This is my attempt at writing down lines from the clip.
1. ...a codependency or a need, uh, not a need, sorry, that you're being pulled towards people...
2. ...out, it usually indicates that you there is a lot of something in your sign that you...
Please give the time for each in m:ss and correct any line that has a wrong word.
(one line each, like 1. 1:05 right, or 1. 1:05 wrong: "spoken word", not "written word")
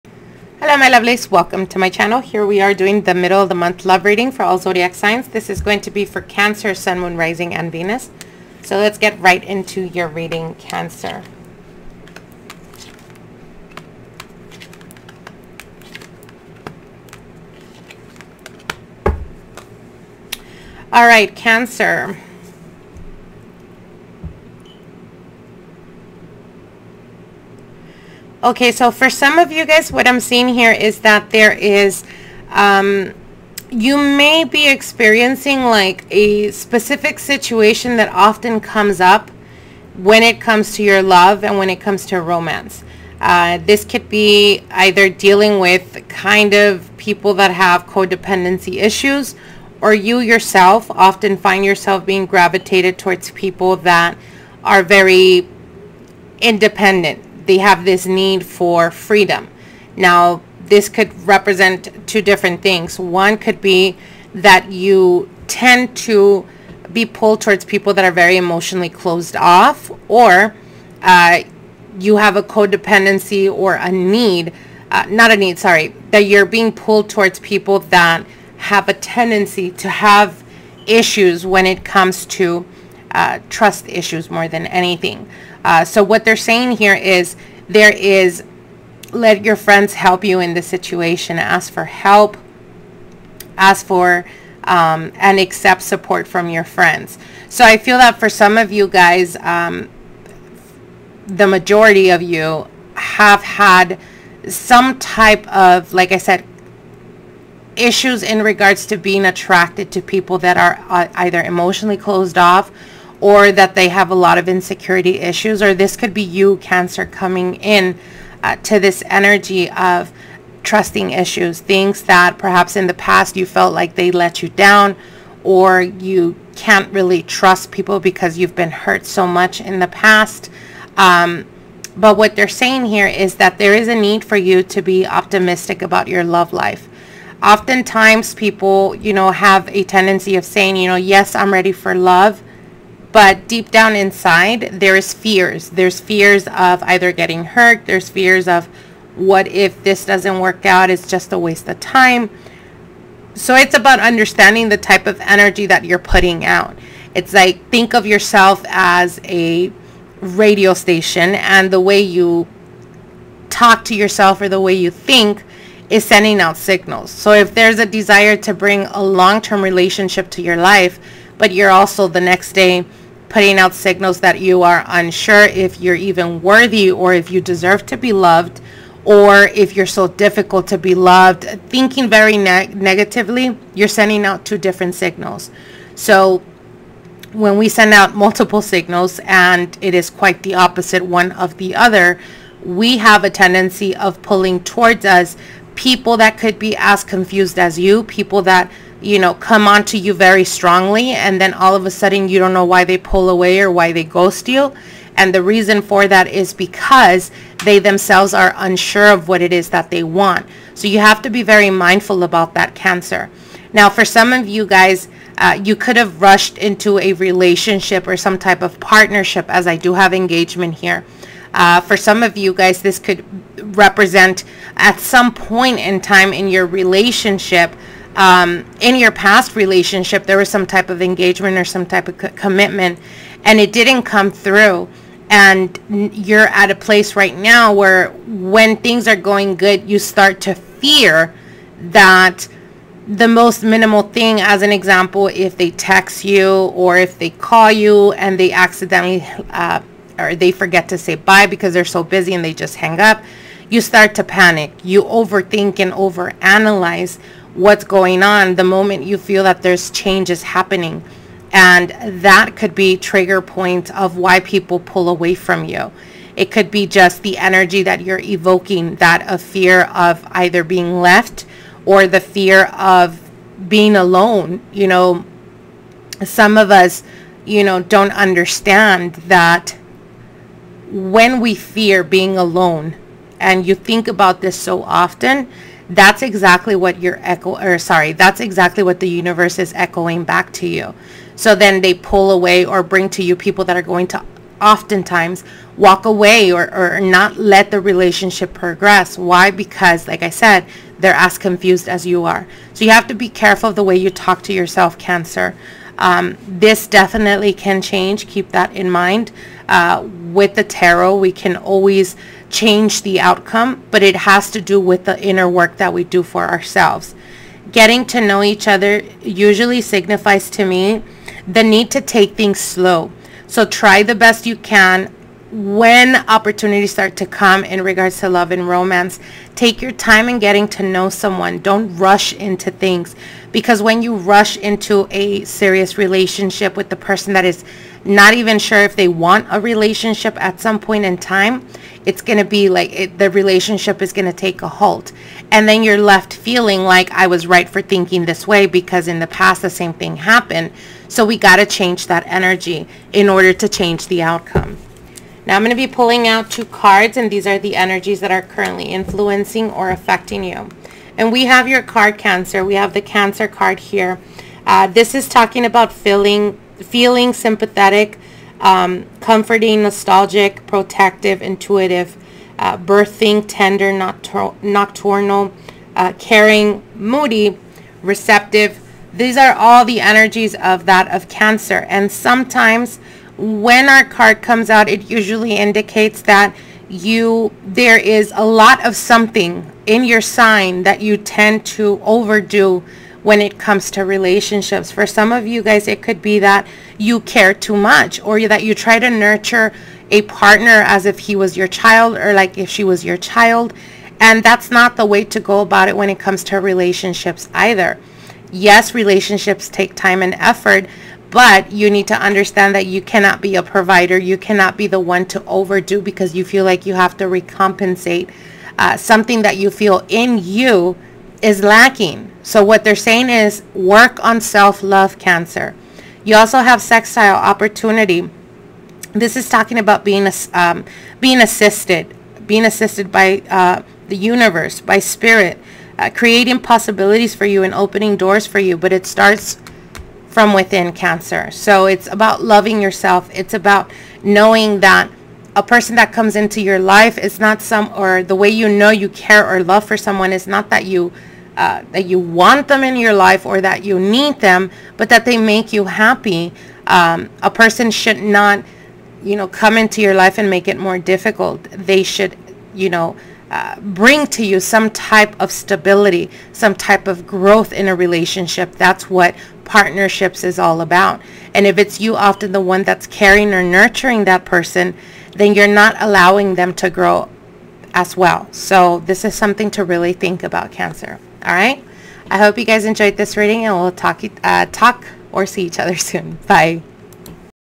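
1. 1:12 right
2. 6:24 right.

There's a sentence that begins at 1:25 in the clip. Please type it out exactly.
Uh, so what they're saying here is there is let your friends help you in the situation.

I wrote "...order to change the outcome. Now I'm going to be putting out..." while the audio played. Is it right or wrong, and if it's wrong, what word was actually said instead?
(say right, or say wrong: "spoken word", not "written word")
wrong: "pulling", not "putting".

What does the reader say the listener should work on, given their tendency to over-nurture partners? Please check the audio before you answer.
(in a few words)
self-love.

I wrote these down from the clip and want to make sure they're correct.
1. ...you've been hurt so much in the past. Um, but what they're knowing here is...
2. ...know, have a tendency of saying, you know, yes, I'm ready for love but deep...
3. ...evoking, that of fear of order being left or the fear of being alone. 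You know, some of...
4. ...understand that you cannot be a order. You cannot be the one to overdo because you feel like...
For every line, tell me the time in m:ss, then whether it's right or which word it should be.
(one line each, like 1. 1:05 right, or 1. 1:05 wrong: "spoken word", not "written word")
1. 2:08 wrong: "saying", not "knowing"
2. 2:19 right
3. 4:28 wrong: "either", not "order"
4. 6:52 wrong: "provider", not "order".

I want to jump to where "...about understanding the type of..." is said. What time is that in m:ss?
2:33.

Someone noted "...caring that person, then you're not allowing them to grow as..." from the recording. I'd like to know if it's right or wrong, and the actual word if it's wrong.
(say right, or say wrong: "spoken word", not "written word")
wrong: "nurturing", not "caring".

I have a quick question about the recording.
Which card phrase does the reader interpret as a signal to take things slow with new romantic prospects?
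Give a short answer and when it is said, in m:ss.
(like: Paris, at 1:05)
Getting to know each other, at 5:17.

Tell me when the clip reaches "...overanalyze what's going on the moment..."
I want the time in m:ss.
4:15.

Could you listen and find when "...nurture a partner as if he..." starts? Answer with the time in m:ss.
6:39.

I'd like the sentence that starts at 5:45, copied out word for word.
And then you're left feeling like I was right for thinking this way because in the past the same thing happened.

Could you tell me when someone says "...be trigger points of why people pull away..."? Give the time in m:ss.
4:22.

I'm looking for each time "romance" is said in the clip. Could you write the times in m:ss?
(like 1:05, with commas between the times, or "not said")
0:42, 5:28.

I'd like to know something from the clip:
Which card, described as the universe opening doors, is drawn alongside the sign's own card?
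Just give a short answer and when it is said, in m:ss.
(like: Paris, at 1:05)
sextile opportunity, at 7:06.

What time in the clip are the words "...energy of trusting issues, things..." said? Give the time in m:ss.
1:59.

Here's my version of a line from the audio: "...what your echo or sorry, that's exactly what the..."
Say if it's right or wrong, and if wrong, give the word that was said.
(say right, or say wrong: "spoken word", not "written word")
right.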